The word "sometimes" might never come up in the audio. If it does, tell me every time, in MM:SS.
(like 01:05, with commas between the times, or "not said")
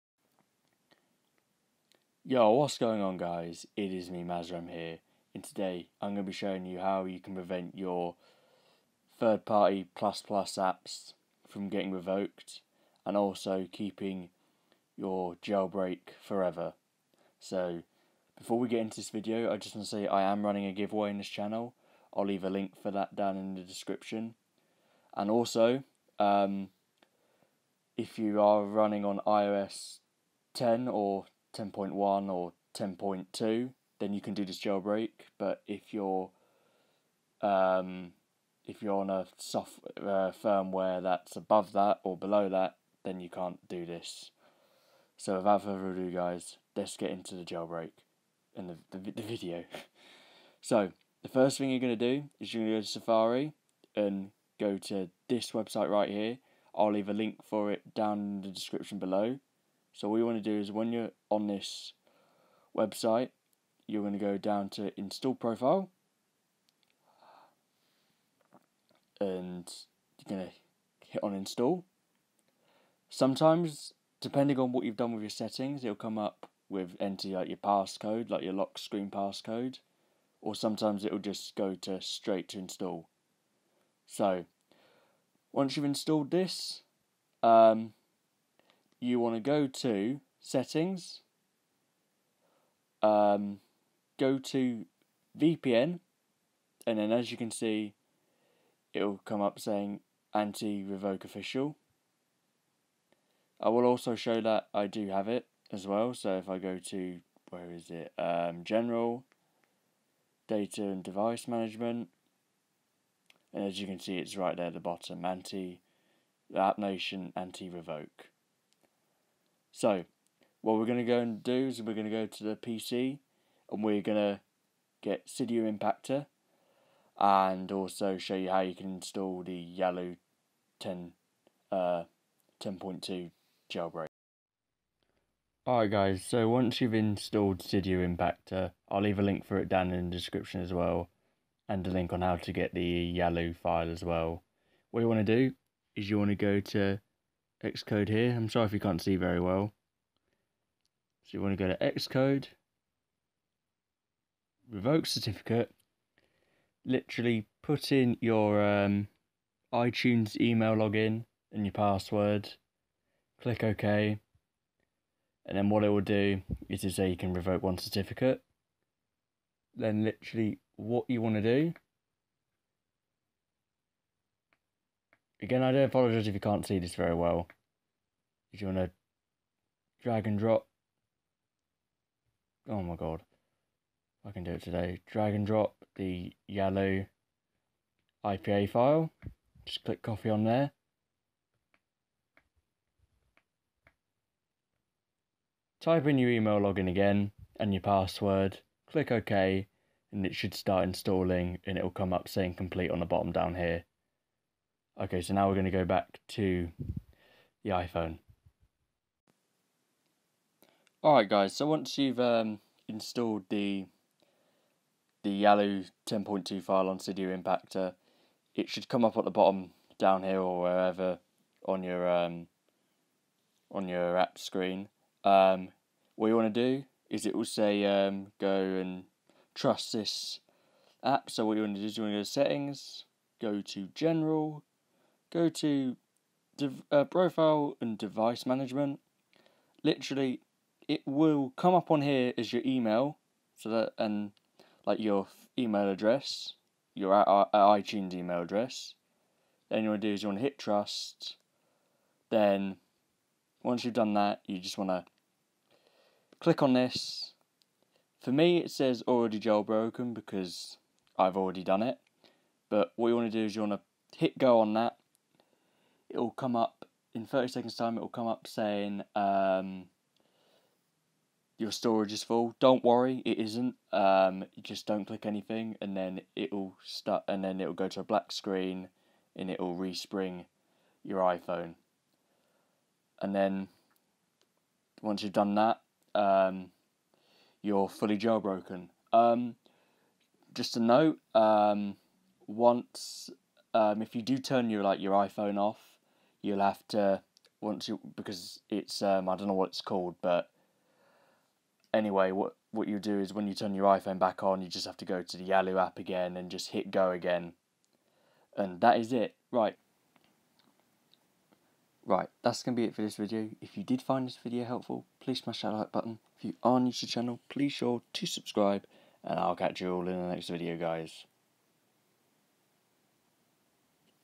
01:13, 01:20.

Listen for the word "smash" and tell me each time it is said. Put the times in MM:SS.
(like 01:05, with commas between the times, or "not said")
05:15.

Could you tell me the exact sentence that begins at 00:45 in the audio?
So without further ado, guys, let's get into the jailbreak and the, the, the video.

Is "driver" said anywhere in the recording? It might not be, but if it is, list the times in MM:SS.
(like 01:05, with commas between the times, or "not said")
not said.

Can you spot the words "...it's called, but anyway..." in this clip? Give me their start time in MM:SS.
04:59.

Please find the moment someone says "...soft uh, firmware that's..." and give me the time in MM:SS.
00:39.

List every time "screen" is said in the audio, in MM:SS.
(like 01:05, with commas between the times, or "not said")
01:18, 03:44, 04:38.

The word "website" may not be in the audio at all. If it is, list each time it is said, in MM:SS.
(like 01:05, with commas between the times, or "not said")
00:55, 01:02.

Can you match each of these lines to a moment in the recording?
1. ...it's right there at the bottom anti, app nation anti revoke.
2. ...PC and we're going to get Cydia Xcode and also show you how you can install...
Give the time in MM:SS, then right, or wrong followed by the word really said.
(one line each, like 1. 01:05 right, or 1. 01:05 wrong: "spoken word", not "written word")
1. 01:54 right
2. 02:02 wrong: "Impactor", not "Xcode".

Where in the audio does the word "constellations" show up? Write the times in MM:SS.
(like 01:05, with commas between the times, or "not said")
not said.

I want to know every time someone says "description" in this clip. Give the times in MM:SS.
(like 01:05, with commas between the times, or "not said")
00:23, 00:58, 02:20.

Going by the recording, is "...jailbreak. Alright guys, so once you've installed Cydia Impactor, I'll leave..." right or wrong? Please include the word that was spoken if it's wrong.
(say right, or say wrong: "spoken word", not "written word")
right.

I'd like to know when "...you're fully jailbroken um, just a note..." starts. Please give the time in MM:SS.
04:47.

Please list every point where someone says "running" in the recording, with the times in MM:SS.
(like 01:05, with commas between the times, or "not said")
00:20, 00:28.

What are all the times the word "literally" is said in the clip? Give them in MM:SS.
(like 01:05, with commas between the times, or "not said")
02:36, 02:50, 03:59.